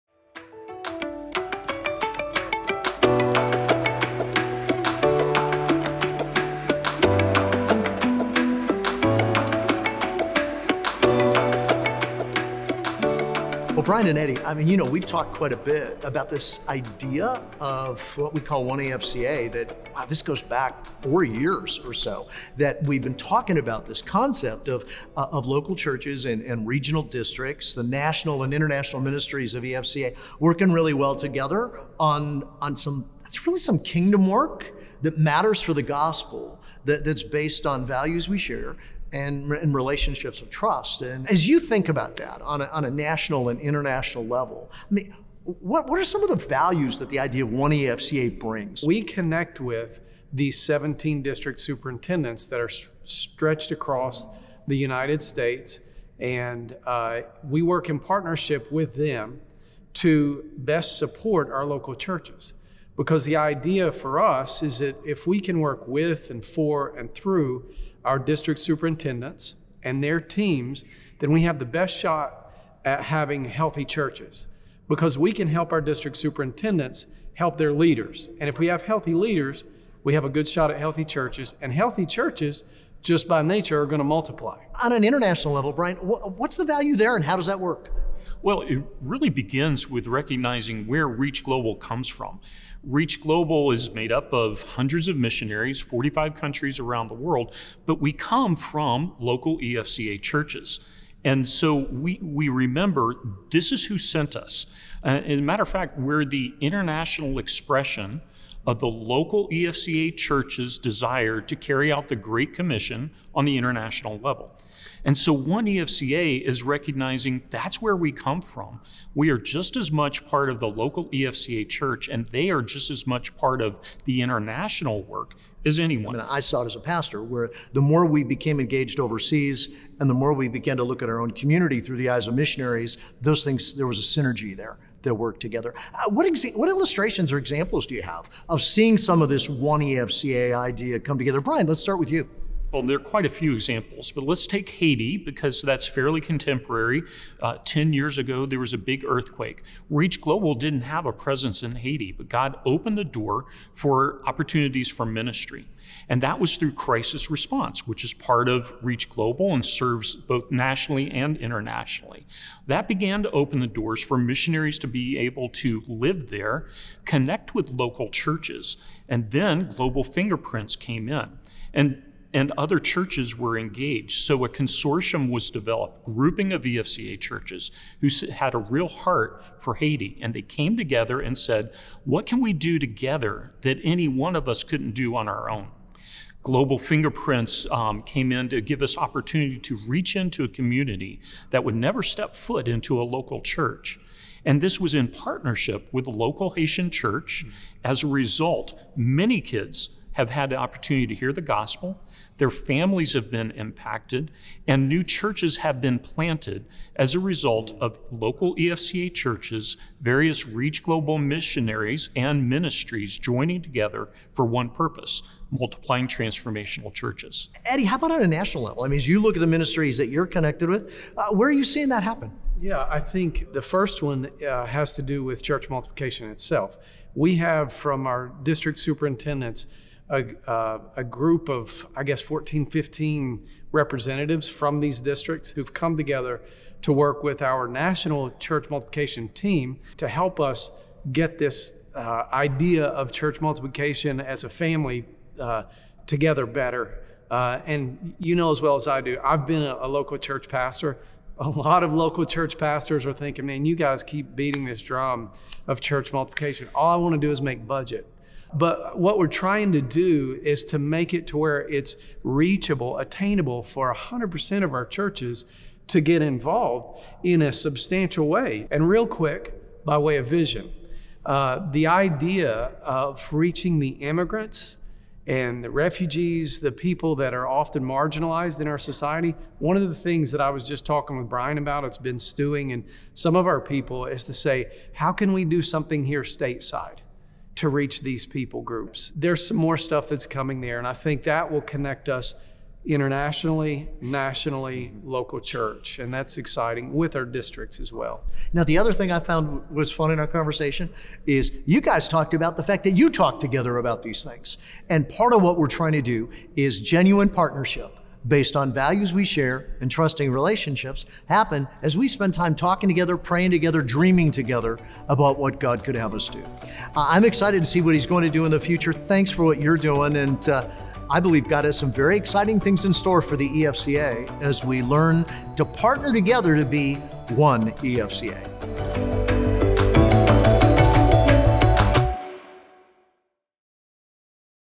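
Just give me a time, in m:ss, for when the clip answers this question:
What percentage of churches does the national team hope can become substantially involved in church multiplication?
4:23.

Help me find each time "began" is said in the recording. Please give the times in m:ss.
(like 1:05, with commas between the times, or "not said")
2:10, 2:42.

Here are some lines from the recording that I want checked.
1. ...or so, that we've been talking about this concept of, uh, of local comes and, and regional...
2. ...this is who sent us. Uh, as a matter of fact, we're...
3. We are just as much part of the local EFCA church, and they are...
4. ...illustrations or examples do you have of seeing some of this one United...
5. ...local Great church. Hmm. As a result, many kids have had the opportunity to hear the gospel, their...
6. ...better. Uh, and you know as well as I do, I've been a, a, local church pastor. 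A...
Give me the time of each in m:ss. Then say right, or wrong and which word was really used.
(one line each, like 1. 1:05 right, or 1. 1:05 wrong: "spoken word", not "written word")
1. 0:21 wrong: "churches", not "comes"
2. 1:43 right
3. 1:59 right
4. 2:16 wrong: "EFCA", not "United"
5. 3:16 wrong: "Haitian", not "Great"
6. 4:06 right.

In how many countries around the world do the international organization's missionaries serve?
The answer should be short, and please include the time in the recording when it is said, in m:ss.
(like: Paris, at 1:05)
45, at 1:35.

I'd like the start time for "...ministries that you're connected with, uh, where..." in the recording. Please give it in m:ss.
3:39.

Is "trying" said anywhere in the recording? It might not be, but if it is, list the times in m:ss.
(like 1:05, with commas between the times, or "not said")
4:19, 5:05.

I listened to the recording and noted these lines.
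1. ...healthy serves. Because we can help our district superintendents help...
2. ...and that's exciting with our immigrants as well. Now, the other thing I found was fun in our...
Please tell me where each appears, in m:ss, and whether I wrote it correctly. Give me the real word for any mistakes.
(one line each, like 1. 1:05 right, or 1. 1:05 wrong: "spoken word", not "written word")
1. 1:13 wrong: "churches", not "serves"
2. 4:55 wrong: "districts", not "immigrants".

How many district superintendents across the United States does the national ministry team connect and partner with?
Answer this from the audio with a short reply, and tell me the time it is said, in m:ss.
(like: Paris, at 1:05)
17, at 0:50.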